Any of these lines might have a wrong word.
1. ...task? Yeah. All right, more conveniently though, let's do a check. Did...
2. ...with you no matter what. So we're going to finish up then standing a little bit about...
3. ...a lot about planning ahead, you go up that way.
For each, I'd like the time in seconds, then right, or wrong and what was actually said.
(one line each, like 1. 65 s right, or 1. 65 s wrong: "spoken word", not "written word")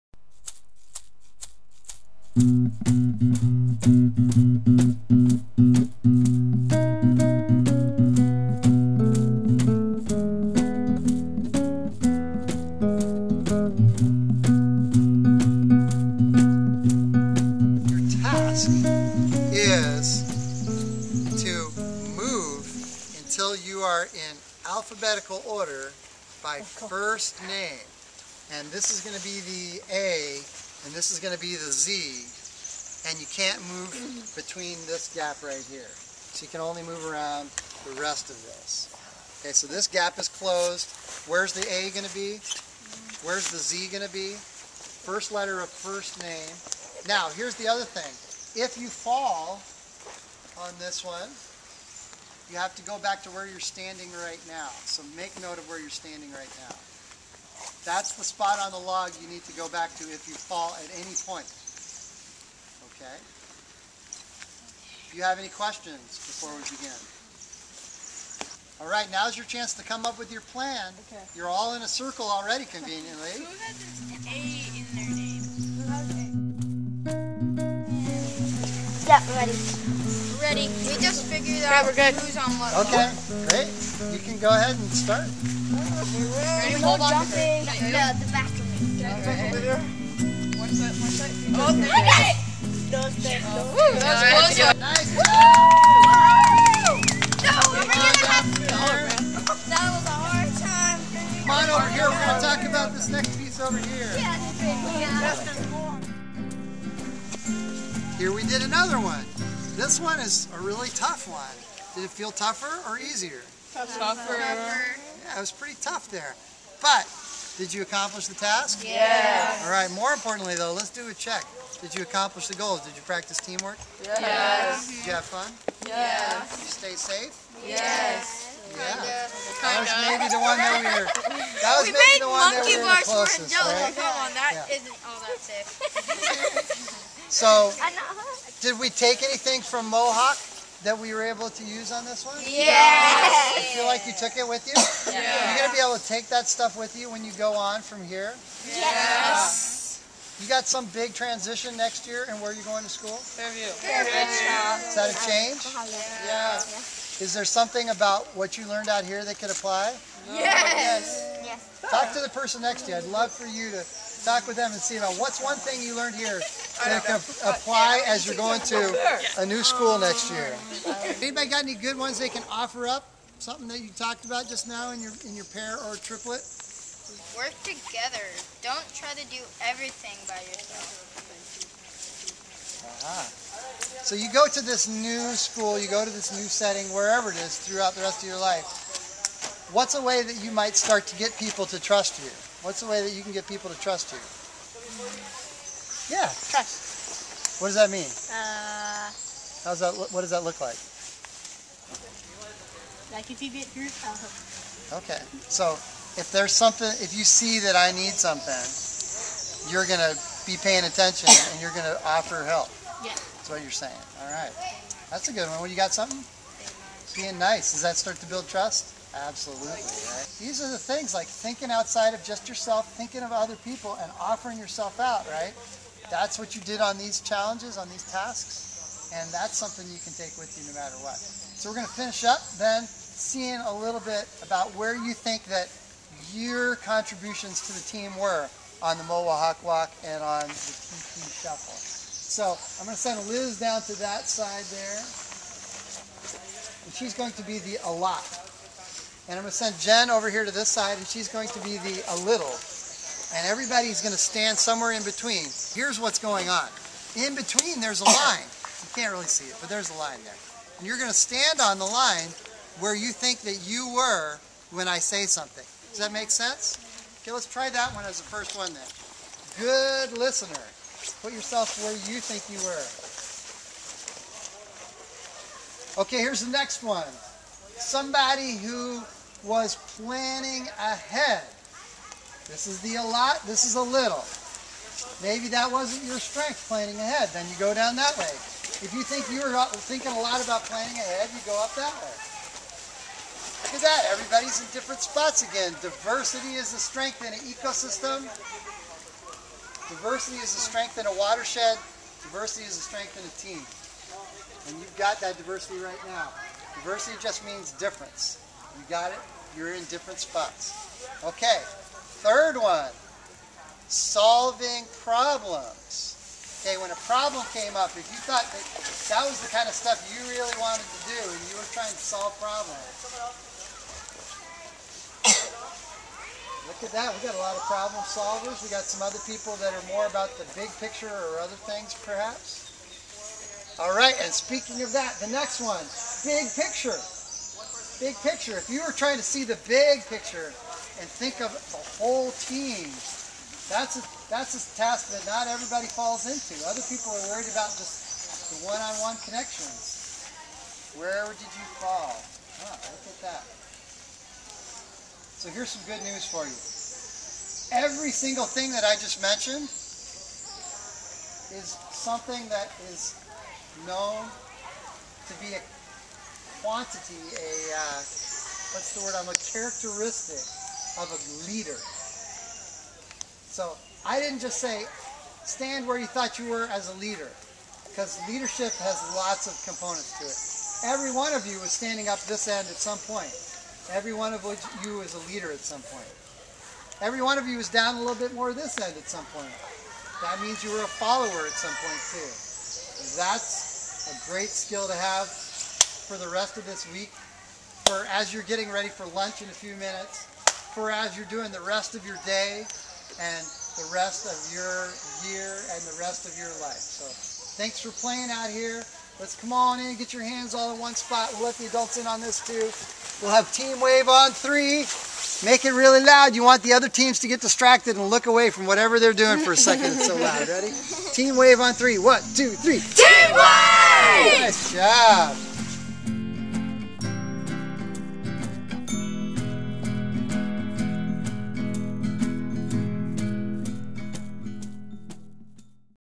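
1. 118 s wrong: "importantly", not "conveniently"
2. 230 s wrong: "seeing", not "standing"
3. 290 s right.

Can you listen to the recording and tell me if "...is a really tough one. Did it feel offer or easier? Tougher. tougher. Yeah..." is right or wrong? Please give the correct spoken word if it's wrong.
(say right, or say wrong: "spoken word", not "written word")
wrong: "tougher", not "offer".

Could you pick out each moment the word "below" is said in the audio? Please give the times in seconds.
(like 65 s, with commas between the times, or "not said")
not said.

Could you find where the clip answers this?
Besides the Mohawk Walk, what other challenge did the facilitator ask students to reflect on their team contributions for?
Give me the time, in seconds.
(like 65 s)
240 s.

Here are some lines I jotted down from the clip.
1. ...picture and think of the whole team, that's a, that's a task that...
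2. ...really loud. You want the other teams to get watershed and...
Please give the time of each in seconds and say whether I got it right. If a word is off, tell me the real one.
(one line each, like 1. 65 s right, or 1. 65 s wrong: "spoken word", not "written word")
1. 340 s right
2. 415 s wrong: "distracted", not "watershed".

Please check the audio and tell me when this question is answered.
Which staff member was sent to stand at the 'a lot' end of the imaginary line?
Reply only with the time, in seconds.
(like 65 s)
243 s.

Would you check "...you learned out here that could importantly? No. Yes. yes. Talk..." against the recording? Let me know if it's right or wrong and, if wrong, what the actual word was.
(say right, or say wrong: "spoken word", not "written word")
wrong: "apply", not "importantly".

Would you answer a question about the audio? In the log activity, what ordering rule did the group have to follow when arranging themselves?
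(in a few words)
Alphabetical order by first name.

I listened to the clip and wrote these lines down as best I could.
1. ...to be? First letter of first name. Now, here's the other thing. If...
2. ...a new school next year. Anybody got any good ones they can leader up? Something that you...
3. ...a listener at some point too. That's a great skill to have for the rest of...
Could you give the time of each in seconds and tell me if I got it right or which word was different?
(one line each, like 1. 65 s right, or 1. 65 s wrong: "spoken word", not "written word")
1. 44 s right
2. 169 s wrong: "offer", not "leader"
3. 390 s wrong: "follower", not "listener".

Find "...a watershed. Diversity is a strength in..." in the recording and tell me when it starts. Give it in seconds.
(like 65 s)
301 s.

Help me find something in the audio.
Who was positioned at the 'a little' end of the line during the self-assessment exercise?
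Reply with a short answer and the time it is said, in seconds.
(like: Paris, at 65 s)
Jen, at 249 s.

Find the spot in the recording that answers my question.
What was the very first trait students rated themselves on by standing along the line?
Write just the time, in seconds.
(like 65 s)
269 s.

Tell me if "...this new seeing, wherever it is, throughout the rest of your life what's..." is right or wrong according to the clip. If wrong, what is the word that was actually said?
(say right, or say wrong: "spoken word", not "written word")
wrong: "setting", not "seeing".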